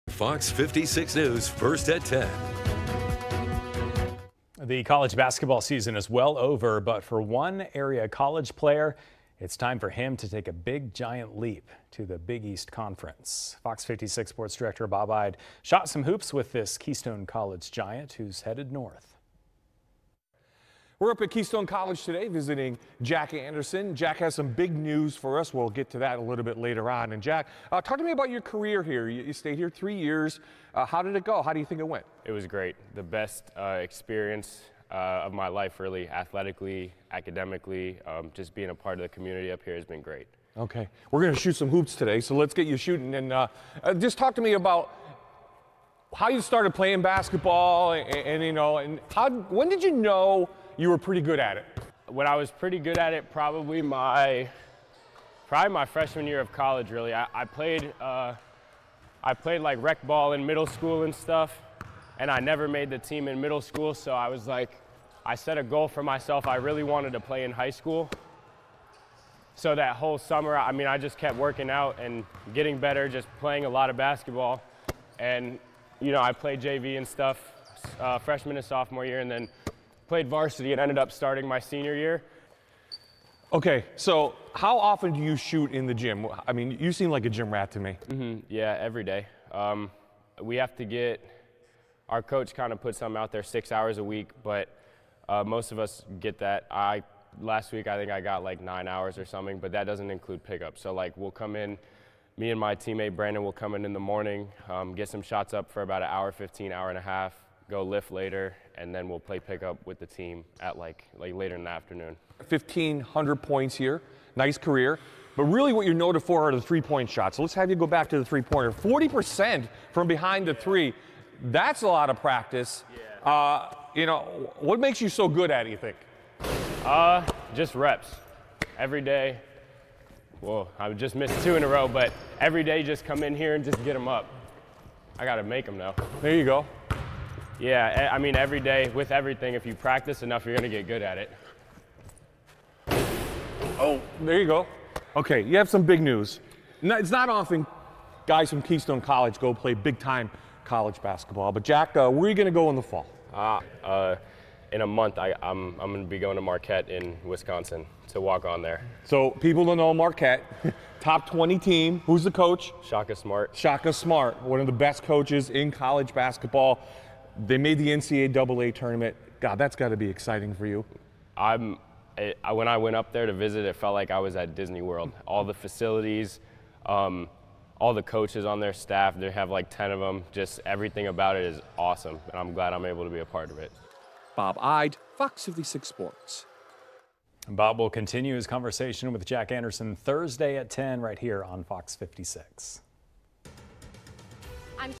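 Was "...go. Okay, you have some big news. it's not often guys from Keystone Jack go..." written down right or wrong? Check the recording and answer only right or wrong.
wrong.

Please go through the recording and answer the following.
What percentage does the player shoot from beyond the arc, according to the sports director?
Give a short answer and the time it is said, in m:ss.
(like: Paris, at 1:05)
40%, at 1:58.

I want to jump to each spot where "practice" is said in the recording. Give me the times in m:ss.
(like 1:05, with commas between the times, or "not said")
2:02, 2:19.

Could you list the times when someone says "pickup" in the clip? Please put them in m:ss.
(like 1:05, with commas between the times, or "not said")
1:40, 1:49.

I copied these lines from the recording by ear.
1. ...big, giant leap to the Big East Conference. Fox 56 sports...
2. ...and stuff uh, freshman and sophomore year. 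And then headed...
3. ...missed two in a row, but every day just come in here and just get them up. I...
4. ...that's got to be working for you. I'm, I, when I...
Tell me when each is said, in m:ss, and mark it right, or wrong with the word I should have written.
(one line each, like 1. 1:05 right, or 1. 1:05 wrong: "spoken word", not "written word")
1. 0:10 right
2. 1:16 wrong: "played", not "headed"
3. 2:11 right
4. 2:49 wrong: "exciting", not "working".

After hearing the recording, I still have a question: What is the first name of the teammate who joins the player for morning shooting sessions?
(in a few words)
Brandon.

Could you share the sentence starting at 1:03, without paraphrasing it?
So I was like, I set a goal for myself.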